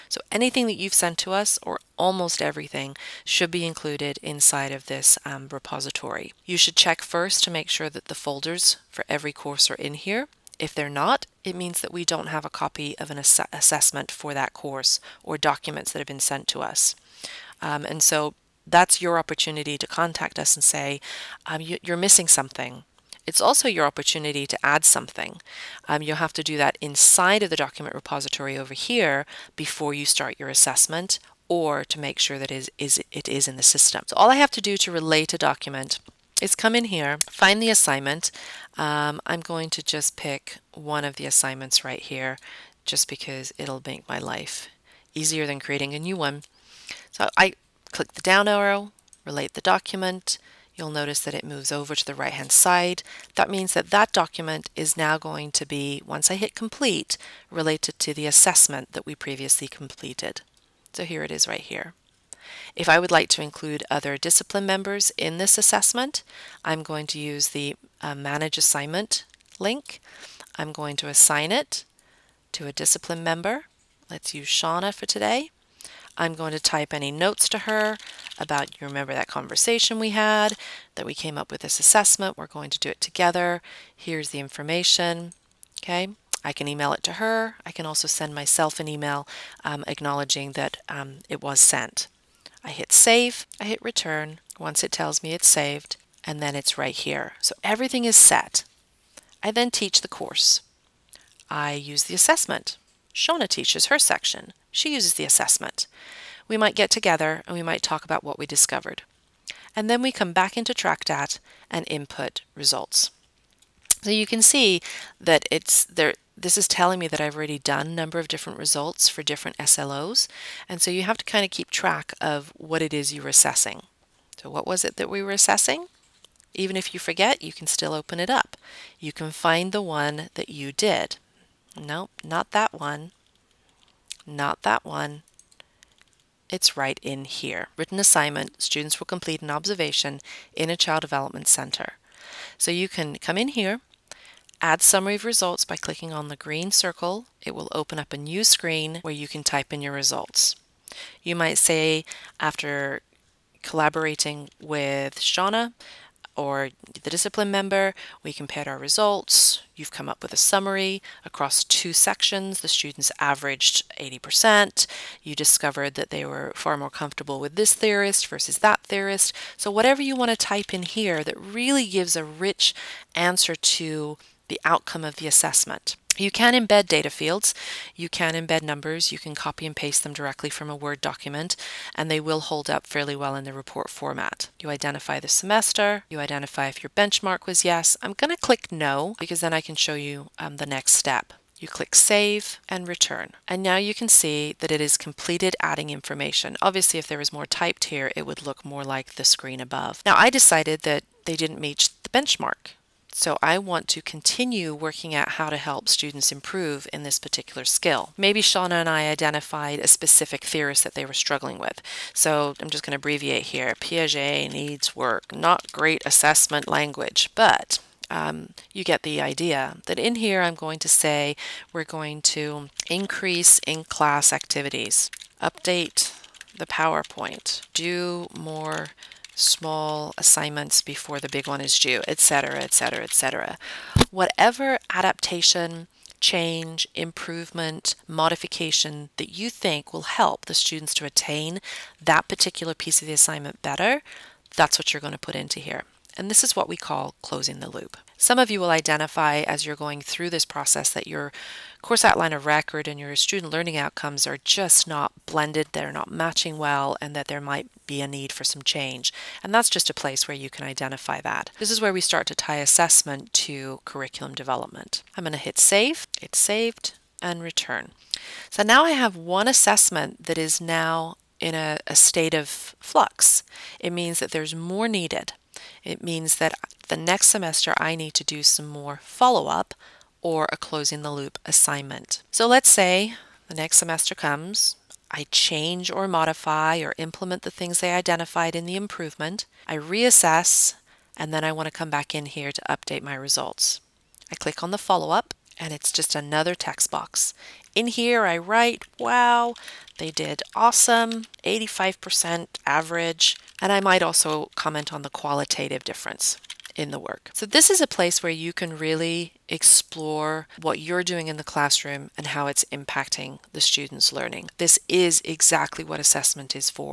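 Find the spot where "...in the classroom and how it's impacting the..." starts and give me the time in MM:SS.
05:11.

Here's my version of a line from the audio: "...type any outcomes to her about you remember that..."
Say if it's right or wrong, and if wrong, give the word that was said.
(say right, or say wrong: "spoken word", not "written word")
wrong: "notes", not "outcomes".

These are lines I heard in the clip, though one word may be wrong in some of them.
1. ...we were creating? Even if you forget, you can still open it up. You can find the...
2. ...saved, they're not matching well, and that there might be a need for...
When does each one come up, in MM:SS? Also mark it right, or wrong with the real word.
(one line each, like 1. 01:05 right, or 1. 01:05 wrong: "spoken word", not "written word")
1. 02:05 wrong: "assessing", not "creating"
2. 04:15 wrong: "blended", not "saved".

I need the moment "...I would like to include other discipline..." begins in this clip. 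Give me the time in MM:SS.
01:02.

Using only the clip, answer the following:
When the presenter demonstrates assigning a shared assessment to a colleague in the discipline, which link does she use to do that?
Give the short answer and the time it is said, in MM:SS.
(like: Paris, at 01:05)
Manage Assignment, at 01:08.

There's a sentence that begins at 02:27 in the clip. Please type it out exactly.
It will open up a new screen where you can type in your results.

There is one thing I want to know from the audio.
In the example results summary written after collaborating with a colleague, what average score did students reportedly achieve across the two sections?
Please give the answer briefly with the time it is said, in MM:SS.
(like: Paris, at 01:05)
80%, at 02:43.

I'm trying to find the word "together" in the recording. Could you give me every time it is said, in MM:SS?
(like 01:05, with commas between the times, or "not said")
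01:22, 01:46.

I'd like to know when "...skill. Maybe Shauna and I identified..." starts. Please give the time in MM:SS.
03:27.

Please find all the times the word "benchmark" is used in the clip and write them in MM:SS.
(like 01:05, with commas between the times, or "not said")
03:06, 03:22.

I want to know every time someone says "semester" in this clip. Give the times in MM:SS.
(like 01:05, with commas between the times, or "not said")
03:05, 04:37, 04:43.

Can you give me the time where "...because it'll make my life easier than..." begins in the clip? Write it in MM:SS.
00:43.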